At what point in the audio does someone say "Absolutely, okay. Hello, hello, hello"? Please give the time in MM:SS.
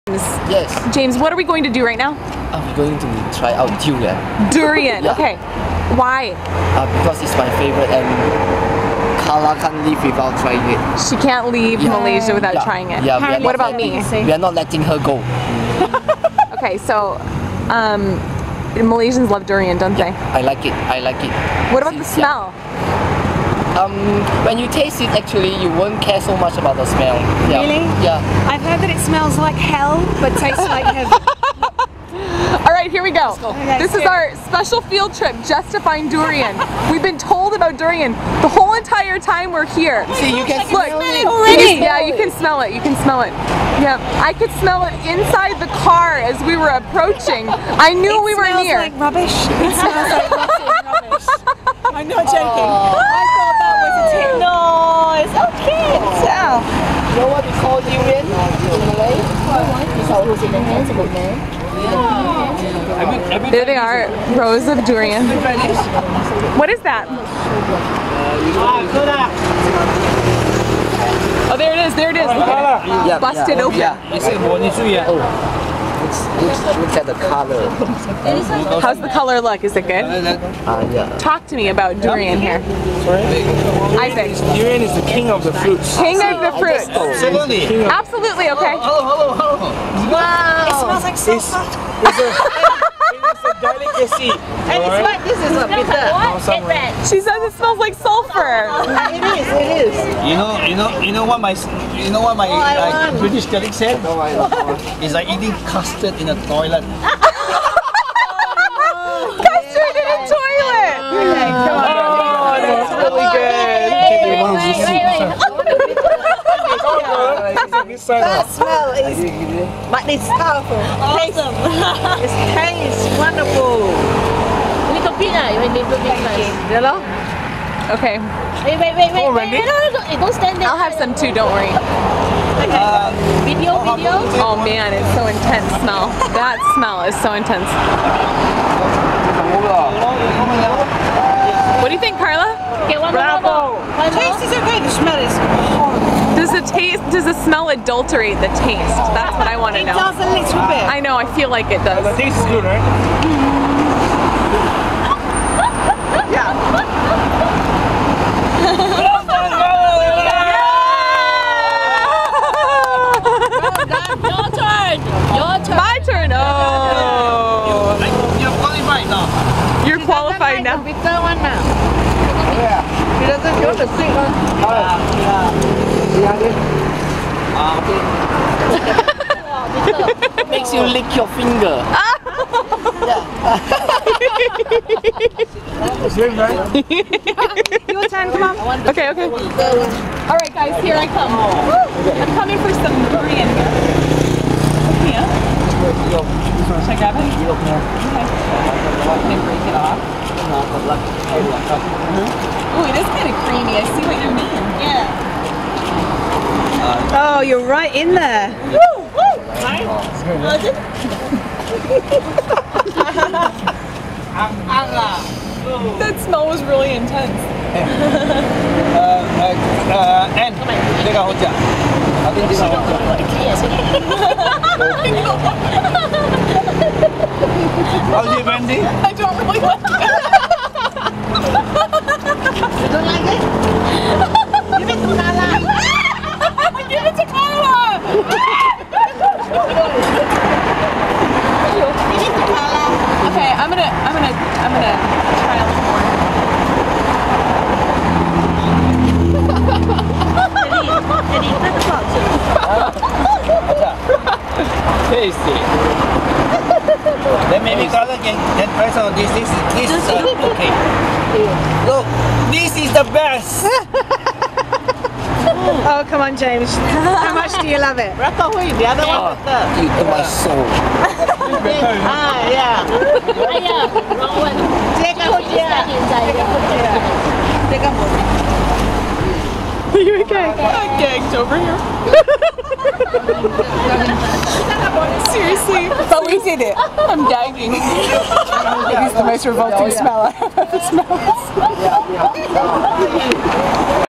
01:27.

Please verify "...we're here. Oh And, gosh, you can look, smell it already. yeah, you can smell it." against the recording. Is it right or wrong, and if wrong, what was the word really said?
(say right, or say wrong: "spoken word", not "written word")
wrong: "See", not "And".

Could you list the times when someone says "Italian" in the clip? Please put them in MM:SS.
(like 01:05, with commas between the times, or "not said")
02:56.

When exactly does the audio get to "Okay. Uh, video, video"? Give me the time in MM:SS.
02:12.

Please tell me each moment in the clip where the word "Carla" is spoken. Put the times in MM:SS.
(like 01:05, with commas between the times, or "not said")
00:09, 02:22.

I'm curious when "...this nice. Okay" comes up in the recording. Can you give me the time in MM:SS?
02:06.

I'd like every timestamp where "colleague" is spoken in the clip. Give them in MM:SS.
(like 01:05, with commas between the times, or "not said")
01:43.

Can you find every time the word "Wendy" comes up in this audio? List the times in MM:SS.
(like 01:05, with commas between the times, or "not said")
03:48.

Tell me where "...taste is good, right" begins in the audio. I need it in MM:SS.
02:32.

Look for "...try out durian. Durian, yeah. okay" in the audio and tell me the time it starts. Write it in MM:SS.
00:03.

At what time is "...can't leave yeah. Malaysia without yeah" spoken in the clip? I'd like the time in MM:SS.
00:11.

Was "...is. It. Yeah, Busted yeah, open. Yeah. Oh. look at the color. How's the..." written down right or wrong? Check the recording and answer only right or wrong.
right.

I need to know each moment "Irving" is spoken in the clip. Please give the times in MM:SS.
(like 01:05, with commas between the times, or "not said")
not said.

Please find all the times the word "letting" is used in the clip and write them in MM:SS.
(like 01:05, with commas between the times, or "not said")
00:14.